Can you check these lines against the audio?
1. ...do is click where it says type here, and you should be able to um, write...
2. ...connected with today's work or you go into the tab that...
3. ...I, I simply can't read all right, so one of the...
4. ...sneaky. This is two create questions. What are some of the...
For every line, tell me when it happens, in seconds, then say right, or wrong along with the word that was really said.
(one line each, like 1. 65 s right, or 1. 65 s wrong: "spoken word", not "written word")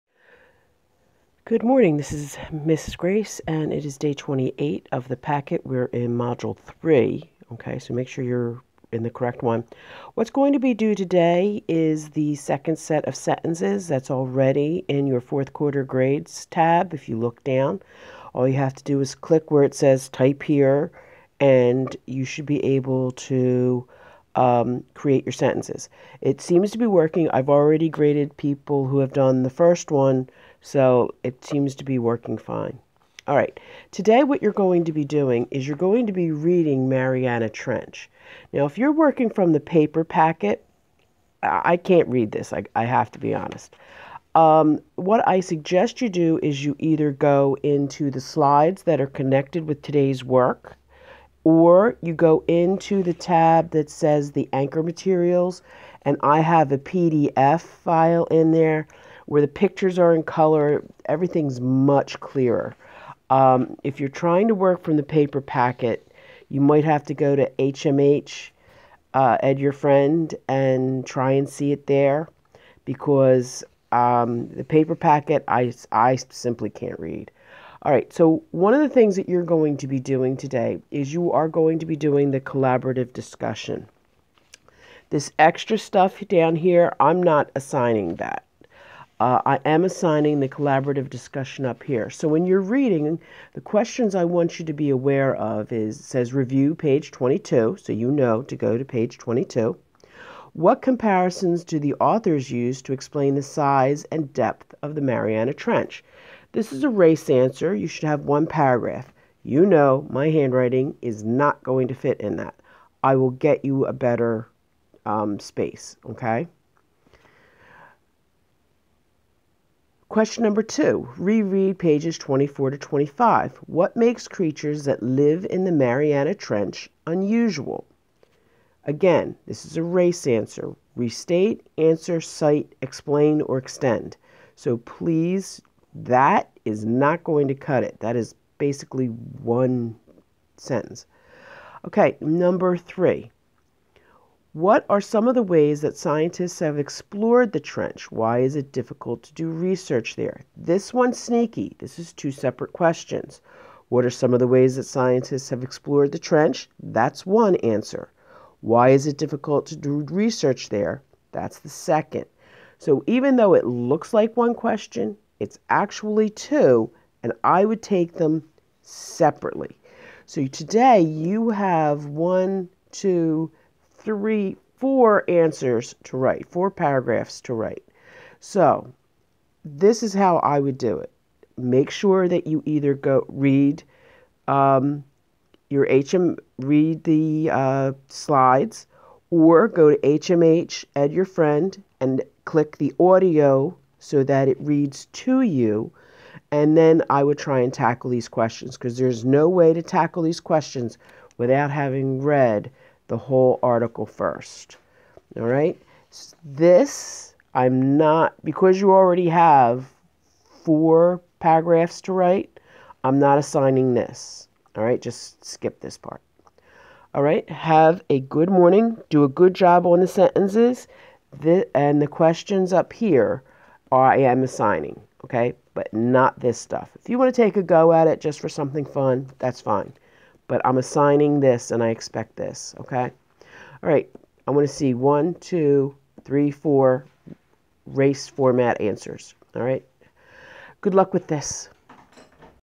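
1. 18 s wrong: "create", not "write"
2. 49 s right
3. 75 s right
4. 151 s wrong: "separate", not "create".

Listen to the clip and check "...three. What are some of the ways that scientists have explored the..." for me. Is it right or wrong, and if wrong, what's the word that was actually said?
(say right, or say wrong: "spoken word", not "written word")
right.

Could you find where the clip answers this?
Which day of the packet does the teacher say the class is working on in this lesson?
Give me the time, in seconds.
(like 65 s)
3 s.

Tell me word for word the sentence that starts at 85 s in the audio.
This extra stuff down here, I'm not assigning that.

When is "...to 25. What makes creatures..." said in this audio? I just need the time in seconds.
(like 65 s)
122 s.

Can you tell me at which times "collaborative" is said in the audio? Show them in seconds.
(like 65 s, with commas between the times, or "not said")
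82 s, 90 s.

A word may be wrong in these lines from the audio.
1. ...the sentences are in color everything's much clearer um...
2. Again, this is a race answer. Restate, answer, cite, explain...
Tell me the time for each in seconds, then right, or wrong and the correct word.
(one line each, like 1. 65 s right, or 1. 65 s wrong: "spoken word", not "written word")
1. 59 s wrong: "pictures", not "sentences"
2. 128 s right.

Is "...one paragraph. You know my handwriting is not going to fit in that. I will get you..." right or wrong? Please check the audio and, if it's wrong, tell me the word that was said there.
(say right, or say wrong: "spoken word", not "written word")
right.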